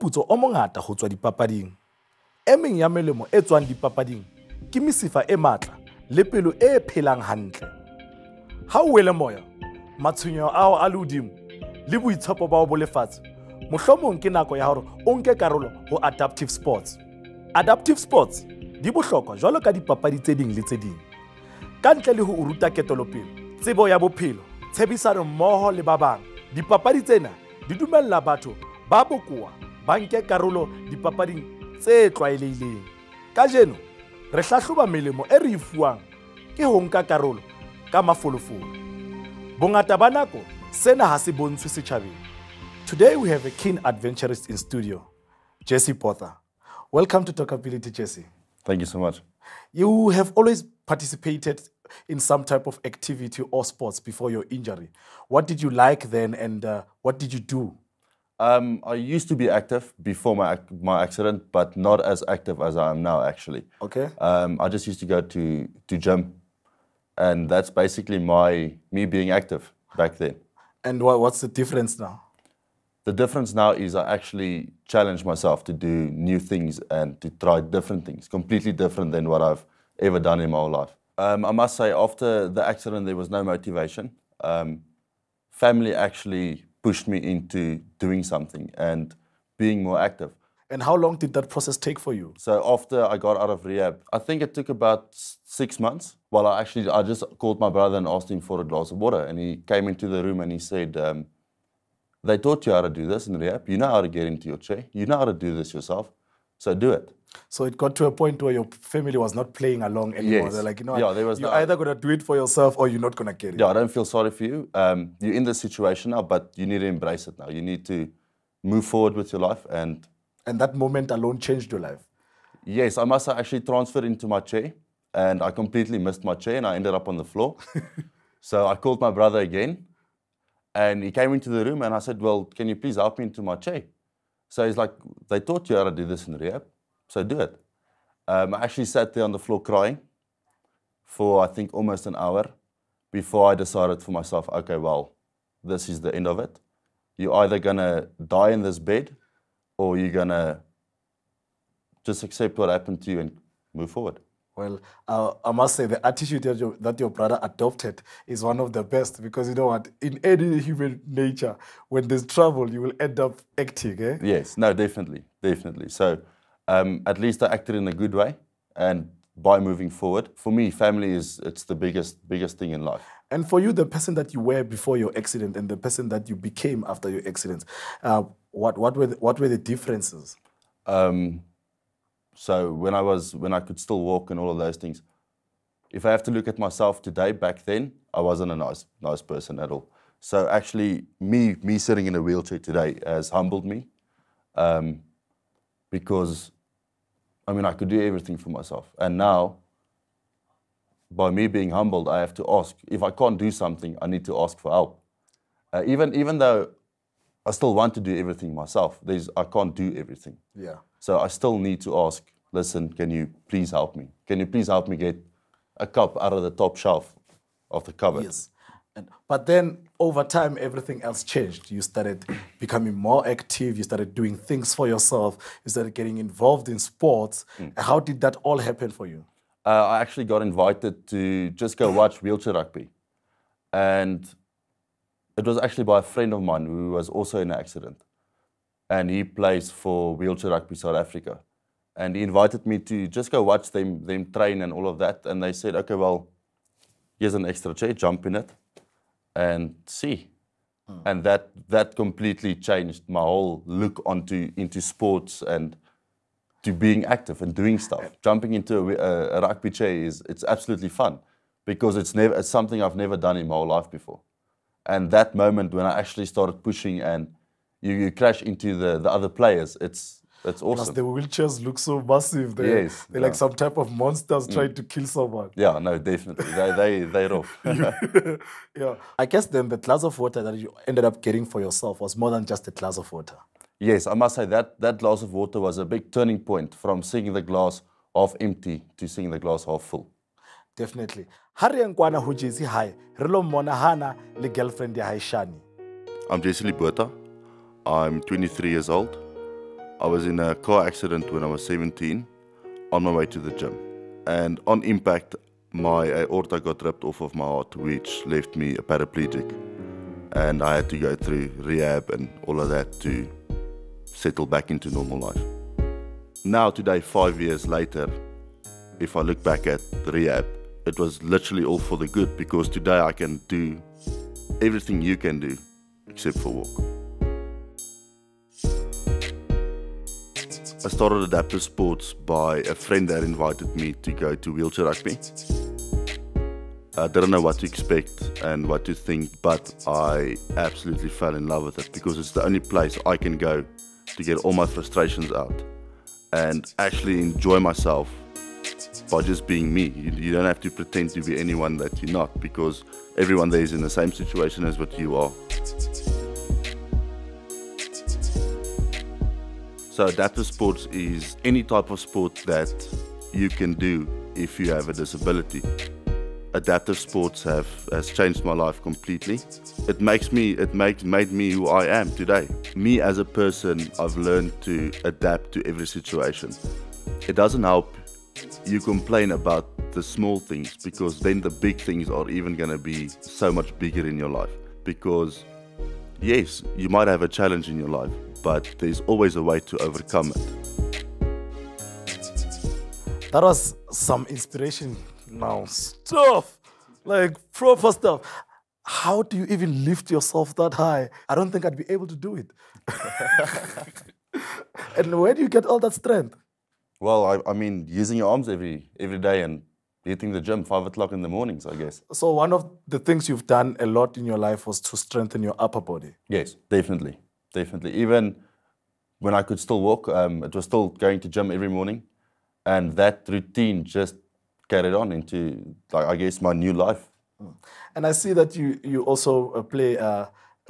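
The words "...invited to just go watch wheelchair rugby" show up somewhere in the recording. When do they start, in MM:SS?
03:50.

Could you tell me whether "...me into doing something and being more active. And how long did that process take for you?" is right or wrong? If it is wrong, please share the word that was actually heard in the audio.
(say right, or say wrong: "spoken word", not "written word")
right.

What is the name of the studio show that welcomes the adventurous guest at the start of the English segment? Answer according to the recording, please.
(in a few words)
Talkability.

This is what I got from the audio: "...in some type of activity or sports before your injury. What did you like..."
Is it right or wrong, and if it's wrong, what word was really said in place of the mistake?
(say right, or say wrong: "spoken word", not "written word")
right.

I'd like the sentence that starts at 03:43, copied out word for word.
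You started doing things for yourself.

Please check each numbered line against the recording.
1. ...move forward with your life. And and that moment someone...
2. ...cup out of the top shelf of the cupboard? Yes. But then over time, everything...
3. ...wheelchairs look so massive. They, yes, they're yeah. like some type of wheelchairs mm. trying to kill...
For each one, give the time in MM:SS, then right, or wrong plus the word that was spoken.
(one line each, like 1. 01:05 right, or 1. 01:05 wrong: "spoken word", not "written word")
1. 01:58 wrong: "alone", not "someone"
2. 03:35 right
3. 04:31 wrong: "monsters", not "wheelchairs".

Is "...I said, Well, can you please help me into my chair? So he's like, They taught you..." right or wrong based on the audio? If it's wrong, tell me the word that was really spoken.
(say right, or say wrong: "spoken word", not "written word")
right.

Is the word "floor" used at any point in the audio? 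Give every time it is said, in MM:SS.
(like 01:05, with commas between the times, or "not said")
02:07, 02:19.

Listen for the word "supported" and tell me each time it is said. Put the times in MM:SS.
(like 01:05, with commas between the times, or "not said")
not said.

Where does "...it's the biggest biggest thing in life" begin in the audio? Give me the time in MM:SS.
02:51.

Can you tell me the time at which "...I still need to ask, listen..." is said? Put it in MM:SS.
03:31.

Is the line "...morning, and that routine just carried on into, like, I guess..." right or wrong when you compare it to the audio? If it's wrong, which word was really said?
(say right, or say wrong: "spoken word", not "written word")
right.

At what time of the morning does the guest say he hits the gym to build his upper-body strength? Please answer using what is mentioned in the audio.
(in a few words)
5 o'clock.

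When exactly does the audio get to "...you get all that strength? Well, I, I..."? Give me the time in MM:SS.
06:45.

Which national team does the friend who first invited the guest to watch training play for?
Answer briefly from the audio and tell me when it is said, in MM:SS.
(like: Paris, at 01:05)
Wheelchair Rugby South Africa, at 04:00.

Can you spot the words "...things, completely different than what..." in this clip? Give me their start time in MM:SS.
01:18.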